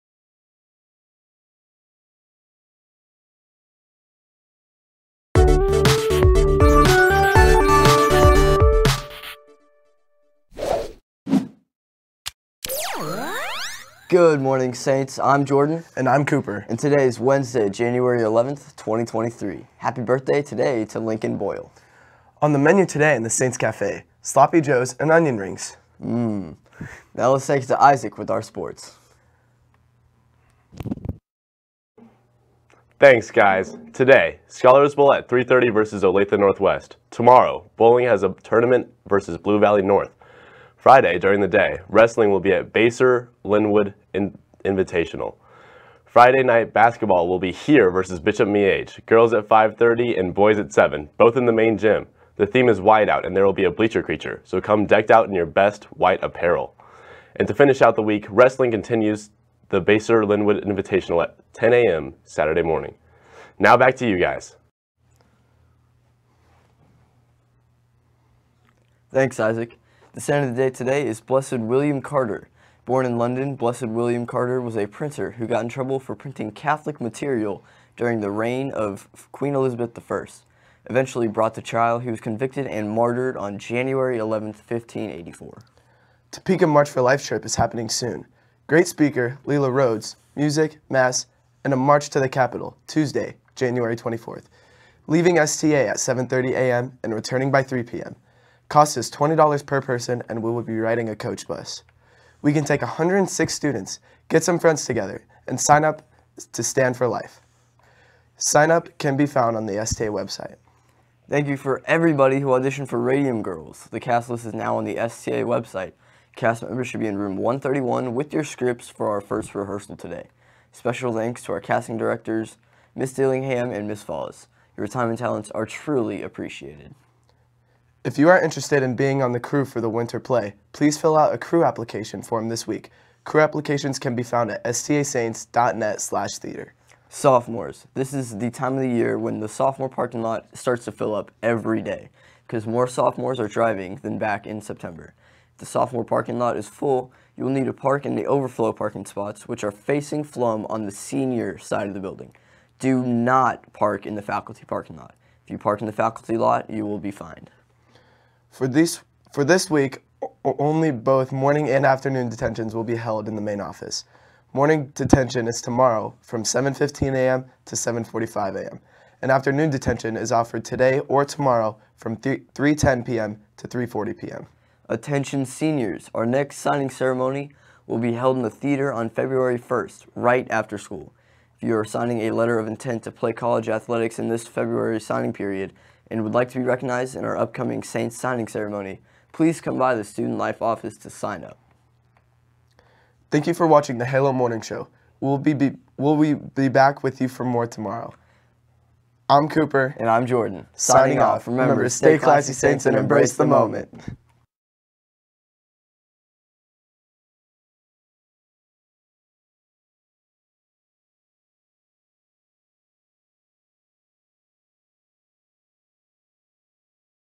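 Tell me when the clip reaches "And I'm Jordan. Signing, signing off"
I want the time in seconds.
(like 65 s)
199 s.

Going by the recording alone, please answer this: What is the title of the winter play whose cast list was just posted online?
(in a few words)
Radium Girls.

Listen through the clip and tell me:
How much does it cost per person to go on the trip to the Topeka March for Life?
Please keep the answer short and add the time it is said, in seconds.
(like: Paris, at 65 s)
$20, at 99 s.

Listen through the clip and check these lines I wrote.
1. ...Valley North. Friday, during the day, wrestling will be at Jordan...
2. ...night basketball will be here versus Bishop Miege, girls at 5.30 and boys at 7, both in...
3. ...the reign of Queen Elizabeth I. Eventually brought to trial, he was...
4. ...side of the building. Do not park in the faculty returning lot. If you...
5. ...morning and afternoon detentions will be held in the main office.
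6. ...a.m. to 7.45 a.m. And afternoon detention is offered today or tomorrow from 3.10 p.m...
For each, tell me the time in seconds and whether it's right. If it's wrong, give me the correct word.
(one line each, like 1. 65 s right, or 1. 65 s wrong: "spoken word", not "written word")
1. 39 s wrong: "Basehor", not "Jordan"
2. 46 s right
3. 78 s right
4. 151 s wrong: "parking", not "returning"
5. 161 s right
6. 167 s right.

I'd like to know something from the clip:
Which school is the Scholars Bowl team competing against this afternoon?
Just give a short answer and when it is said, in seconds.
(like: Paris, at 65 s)
Olathe Northwest, at 36 s.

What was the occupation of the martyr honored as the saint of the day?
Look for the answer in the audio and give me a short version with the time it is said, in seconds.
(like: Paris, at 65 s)
Printer, at 74 s.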